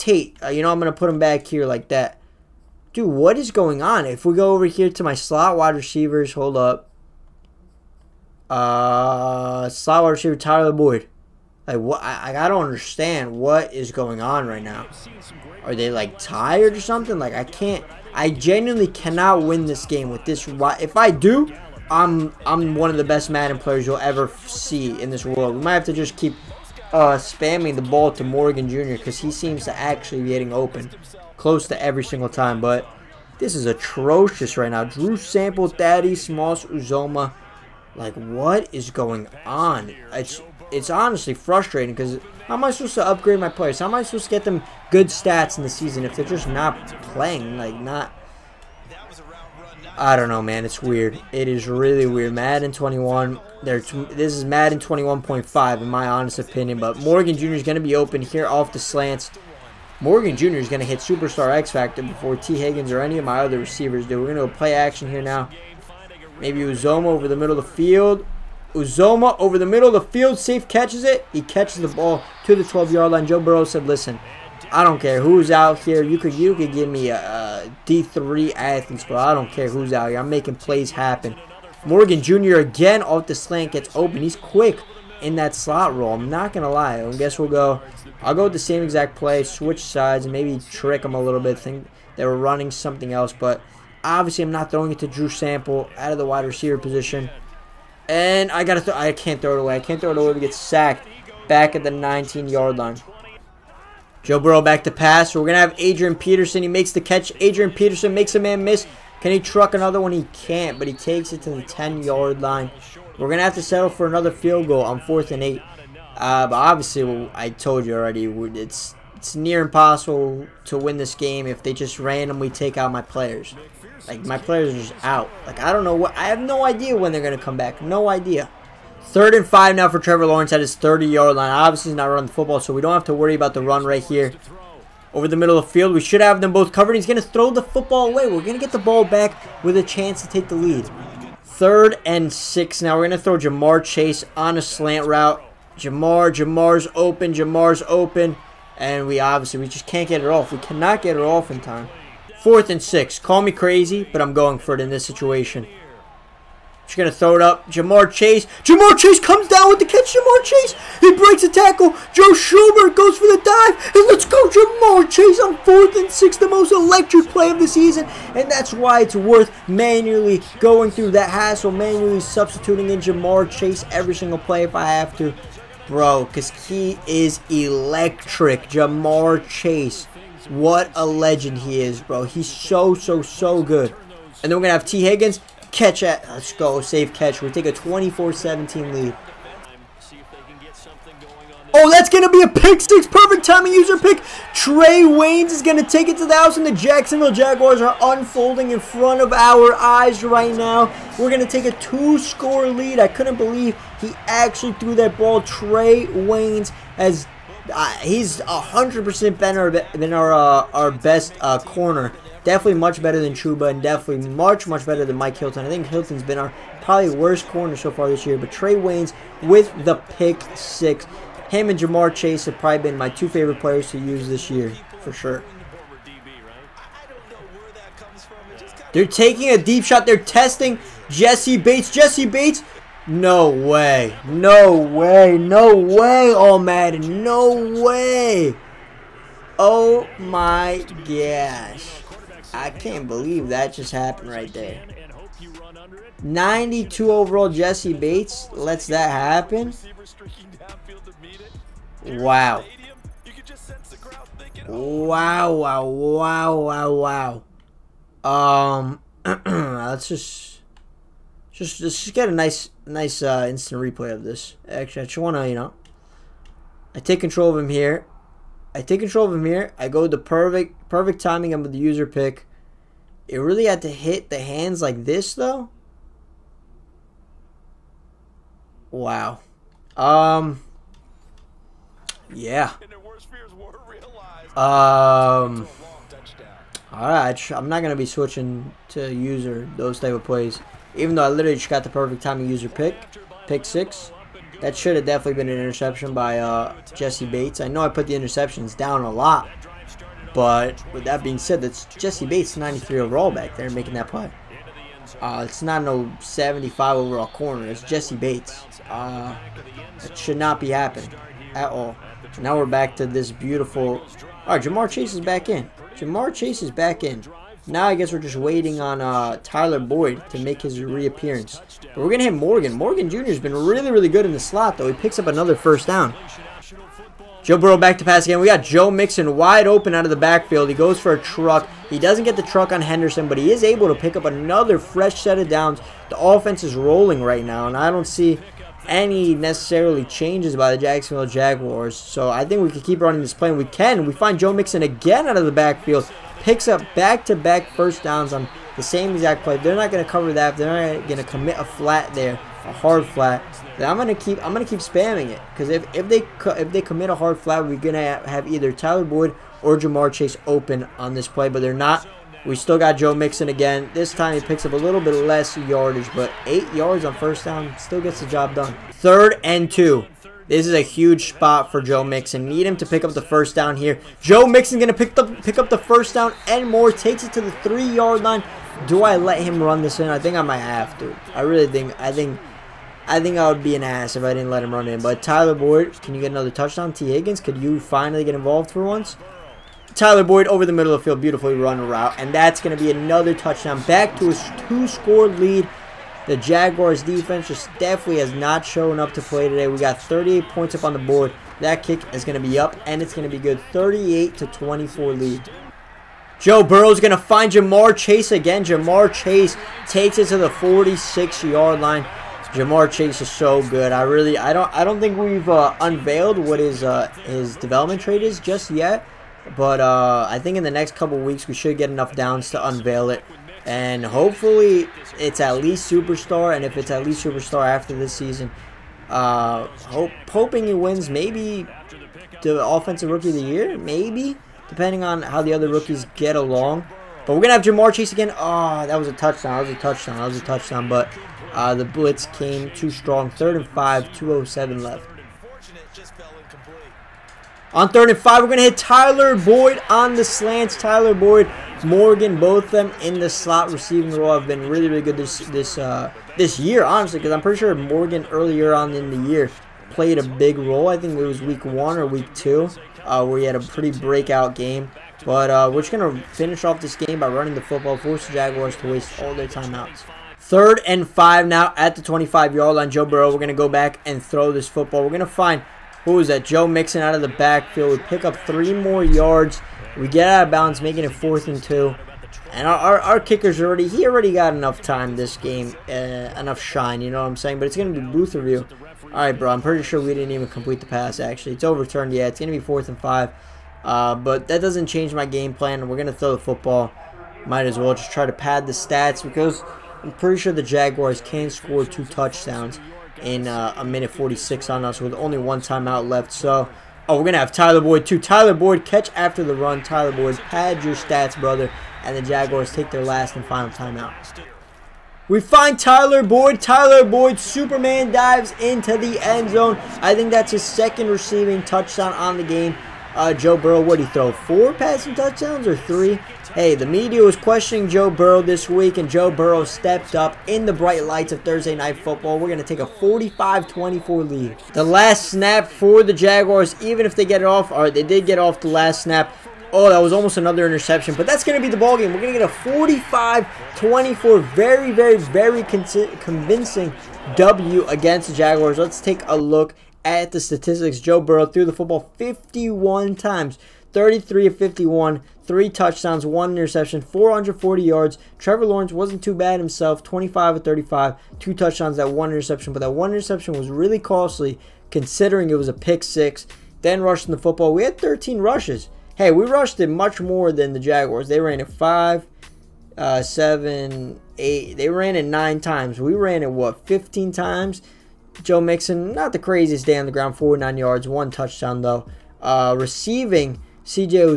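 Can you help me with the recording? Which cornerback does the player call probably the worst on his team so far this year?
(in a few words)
Mike Hilton.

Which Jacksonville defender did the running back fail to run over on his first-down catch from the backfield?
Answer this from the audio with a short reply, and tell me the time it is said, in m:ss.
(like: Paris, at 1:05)
Henderson, at 5:32.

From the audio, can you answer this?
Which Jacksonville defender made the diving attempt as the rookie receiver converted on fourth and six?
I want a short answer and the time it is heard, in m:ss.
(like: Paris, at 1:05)
Joe Schobert, at 2:42.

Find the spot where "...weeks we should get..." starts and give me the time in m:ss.
7:01.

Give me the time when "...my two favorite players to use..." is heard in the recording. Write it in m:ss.
3:42.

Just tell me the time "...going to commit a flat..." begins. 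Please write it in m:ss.
5:51.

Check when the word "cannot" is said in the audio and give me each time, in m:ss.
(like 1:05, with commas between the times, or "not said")
0:18, 2:30.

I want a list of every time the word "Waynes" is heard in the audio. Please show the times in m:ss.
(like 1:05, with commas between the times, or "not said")
3:15, 3:26, 3:38.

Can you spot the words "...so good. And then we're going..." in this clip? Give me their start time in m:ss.
3:03.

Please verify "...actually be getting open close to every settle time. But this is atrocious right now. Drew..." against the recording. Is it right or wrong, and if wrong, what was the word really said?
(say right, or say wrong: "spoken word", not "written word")
wrong: "single", not "settle".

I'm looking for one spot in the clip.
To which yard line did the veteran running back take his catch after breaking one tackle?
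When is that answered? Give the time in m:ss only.
1:51.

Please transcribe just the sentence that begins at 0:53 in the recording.
There, this is Madden 21.5 in my honest opinion.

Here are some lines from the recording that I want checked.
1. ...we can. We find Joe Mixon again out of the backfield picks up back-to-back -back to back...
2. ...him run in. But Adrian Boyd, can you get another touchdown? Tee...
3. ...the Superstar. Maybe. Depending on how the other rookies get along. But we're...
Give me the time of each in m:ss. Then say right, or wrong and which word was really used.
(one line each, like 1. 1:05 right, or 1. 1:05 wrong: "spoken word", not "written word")
1. 5:43 right
2. 6:24 wrong: "Tyler", not "Adrian"
3. 7:13 wrong: "Year", not "Superstar".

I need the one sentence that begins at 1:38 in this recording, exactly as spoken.
And I gotta, I can't throw it away.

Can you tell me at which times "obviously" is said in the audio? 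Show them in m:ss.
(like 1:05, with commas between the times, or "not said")
1:34, 1:56, 2:11, 2:29.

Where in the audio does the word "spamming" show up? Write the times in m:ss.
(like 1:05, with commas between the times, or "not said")
0:27, 5:54.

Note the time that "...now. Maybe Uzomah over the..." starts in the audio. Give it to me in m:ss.
1:05.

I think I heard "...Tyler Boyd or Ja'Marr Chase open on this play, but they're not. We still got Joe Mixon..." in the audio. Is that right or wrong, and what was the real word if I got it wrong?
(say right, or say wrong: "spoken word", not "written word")
right.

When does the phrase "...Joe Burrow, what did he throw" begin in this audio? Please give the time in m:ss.
8:43.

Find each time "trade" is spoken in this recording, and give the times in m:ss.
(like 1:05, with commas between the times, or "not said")
6:58.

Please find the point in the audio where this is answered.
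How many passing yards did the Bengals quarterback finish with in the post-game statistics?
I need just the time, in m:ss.
9:17.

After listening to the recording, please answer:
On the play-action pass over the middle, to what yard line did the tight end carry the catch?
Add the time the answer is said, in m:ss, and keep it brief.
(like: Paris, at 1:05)
12-yard line, at 1:12.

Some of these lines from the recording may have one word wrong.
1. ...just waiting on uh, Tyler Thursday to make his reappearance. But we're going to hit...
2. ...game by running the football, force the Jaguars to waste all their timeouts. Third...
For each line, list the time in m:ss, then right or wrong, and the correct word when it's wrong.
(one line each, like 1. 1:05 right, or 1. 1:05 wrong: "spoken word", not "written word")
1. 5:18 wrong: "Boyd", not "Thursday"
2. 7:46 right.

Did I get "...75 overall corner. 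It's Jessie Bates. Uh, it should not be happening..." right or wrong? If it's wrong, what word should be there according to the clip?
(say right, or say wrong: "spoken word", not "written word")
right.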